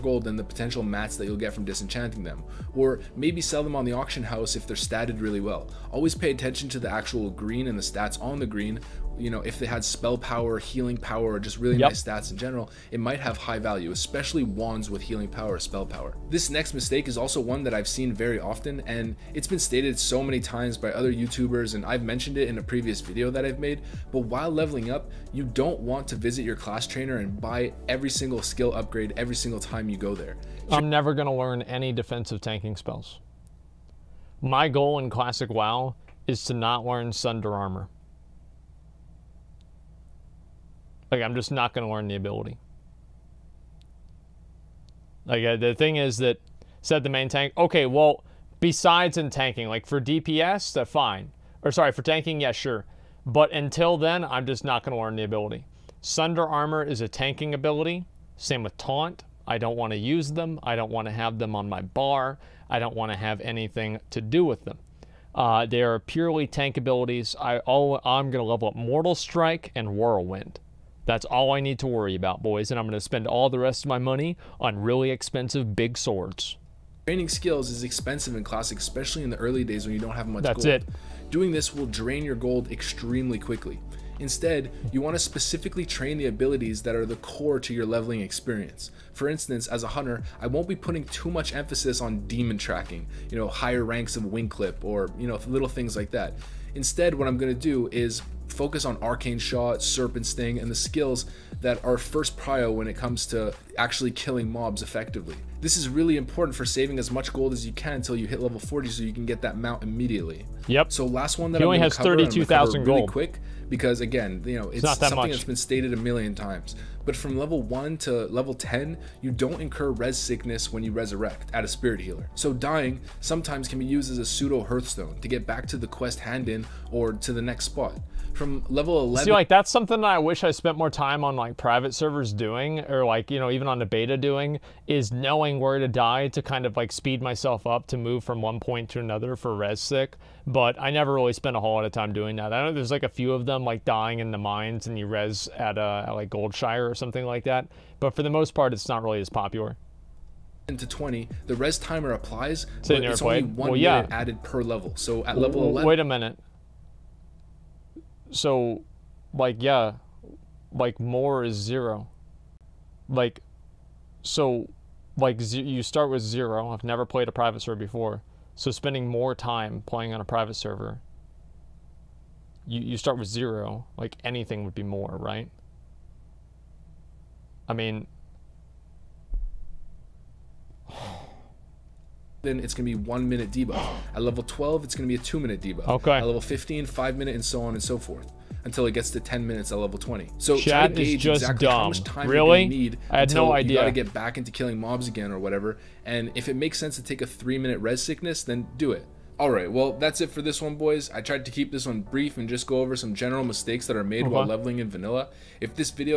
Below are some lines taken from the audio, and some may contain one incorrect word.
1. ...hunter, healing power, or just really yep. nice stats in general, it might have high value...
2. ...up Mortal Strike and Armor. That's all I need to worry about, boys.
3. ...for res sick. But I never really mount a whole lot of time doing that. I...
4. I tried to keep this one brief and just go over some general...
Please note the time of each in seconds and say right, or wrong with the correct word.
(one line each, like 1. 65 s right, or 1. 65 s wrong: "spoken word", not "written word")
1. 10 s wrong: "power", not "hunter"
2. 68 s wrong: "Whirlwind", not "Armor"
3. 139 s wrong: "spent", not "mount"
4. 201 s right.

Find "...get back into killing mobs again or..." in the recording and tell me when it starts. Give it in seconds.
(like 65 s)
193 s.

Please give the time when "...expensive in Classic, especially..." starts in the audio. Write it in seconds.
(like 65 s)
77 s.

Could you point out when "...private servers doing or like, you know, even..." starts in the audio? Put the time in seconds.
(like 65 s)
131 s.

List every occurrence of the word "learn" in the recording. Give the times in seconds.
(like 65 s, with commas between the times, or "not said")
31 s, 36 s, 41 s, 55 s.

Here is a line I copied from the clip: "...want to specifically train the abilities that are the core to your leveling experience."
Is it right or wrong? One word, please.
right.